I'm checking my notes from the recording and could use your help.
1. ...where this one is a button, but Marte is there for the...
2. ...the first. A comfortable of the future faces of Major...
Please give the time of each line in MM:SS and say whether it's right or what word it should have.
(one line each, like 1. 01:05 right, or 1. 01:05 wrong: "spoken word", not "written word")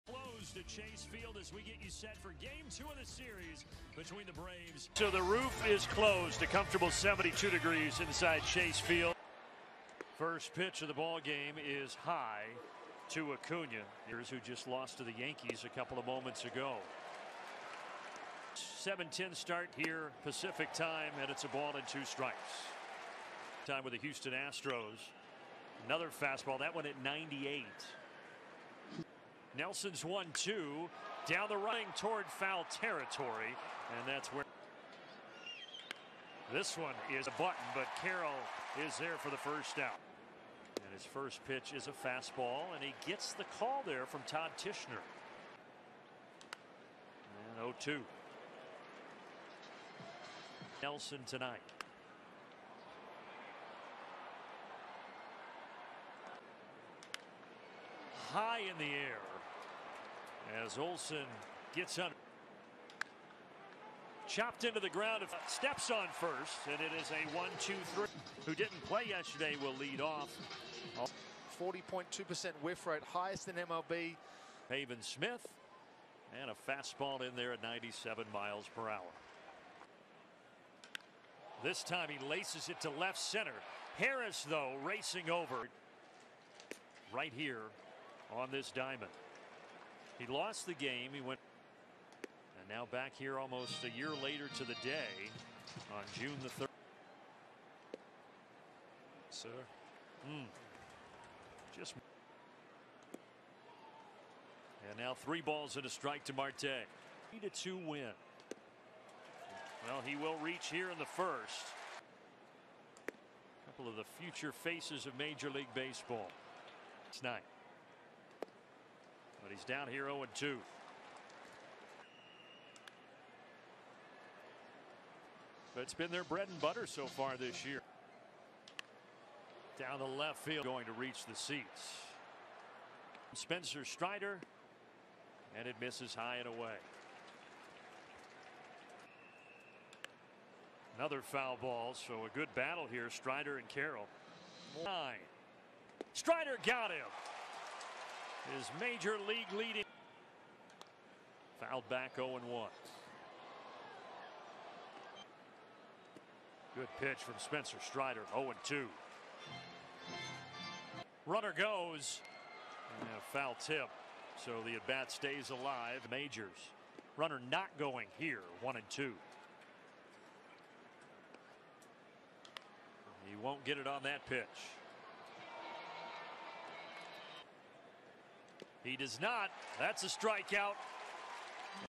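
1. 00:34 wrong: "Carroll", not "Marte"
2. 01:50 wrong: "couple", not "comfortable".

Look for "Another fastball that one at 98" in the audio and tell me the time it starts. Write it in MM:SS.
00:25.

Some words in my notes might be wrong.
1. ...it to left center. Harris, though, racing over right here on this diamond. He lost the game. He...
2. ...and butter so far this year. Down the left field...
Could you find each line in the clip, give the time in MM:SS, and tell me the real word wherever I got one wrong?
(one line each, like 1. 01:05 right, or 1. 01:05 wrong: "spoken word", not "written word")
1. 01:22 right
2. 02:06 right.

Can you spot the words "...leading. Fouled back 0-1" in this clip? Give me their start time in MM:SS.
02:29.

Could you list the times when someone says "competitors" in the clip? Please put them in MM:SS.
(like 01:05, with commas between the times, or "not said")
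not said.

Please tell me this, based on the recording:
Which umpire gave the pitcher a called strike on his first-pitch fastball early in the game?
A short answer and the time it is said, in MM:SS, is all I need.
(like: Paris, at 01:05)
Todd Tichenor, at 00:44.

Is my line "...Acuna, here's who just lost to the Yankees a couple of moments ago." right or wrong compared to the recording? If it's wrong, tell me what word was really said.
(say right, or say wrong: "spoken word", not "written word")
right.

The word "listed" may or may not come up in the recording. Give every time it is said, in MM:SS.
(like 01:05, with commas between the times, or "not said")
not said.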